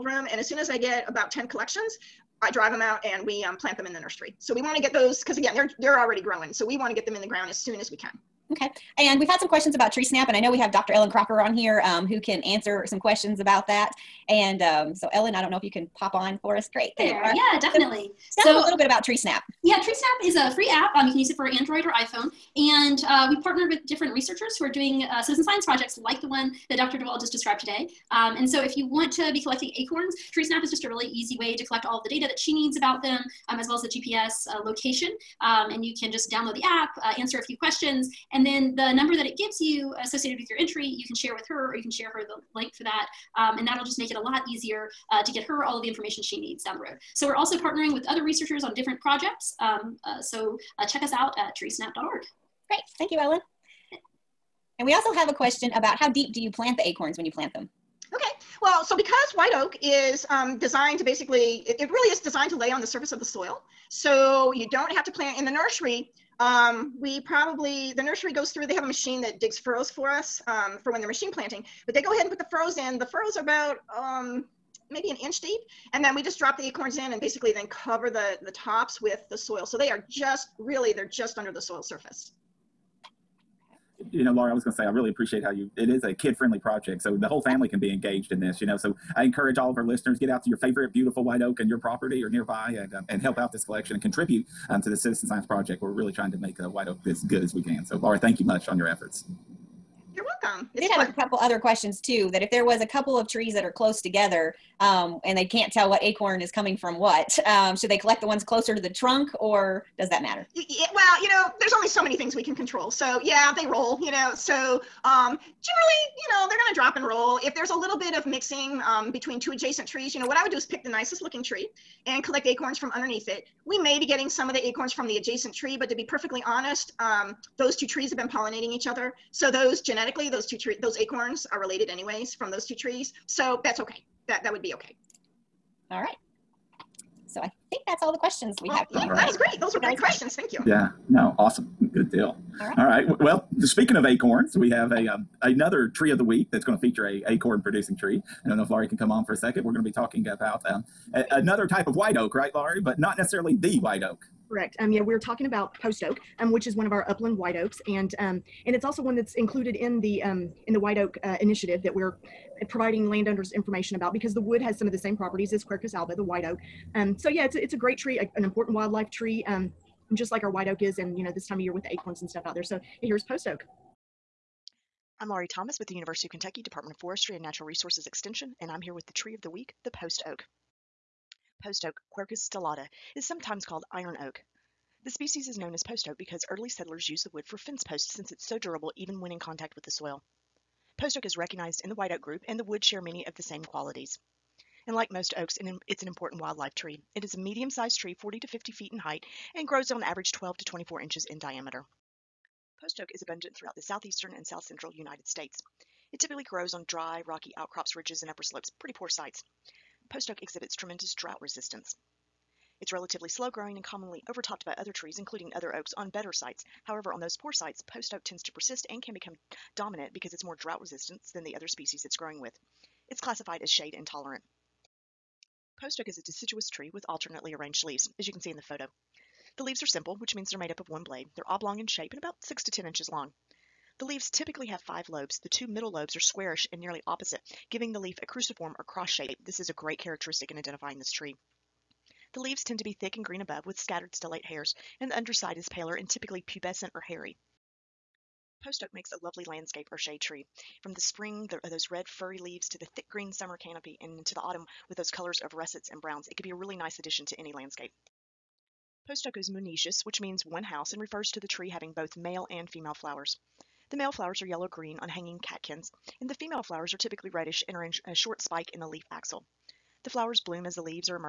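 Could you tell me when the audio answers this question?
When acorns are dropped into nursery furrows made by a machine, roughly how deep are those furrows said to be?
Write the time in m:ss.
1:14.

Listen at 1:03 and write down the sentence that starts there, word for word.
So you don't have to plant in the nursery.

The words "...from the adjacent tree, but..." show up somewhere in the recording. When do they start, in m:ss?
2:04.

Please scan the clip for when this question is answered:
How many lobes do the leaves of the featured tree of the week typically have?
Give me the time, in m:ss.
3:54.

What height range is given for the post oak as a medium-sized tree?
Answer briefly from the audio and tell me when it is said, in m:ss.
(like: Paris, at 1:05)
40 to 50 feet, at 3:18.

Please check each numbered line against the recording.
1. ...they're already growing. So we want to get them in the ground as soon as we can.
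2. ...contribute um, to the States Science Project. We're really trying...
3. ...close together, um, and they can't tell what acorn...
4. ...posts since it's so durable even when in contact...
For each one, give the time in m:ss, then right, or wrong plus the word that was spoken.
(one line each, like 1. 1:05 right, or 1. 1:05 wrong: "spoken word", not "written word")
1. 0:05 right
2. 1:34 wrong: "Citizen", not "States"
3. 1:43 right
4. 3:07 right.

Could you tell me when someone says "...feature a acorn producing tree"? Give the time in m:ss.
2:26.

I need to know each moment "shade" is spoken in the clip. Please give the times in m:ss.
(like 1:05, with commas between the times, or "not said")
3:43, 4:09.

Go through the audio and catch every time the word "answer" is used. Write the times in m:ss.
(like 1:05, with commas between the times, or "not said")
0:12, 0:37.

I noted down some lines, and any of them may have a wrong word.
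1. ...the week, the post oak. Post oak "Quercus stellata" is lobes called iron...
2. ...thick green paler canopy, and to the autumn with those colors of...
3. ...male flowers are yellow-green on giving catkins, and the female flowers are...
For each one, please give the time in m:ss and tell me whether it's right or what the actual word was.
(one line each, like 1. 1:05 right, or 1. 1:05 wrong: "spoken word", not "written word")
1. 2:59 wrong: "sometimes", not "lobes"
2. 4:12 wrong: "summer", not "paler"
3. 4:23 wrong: "hanging", not "giving".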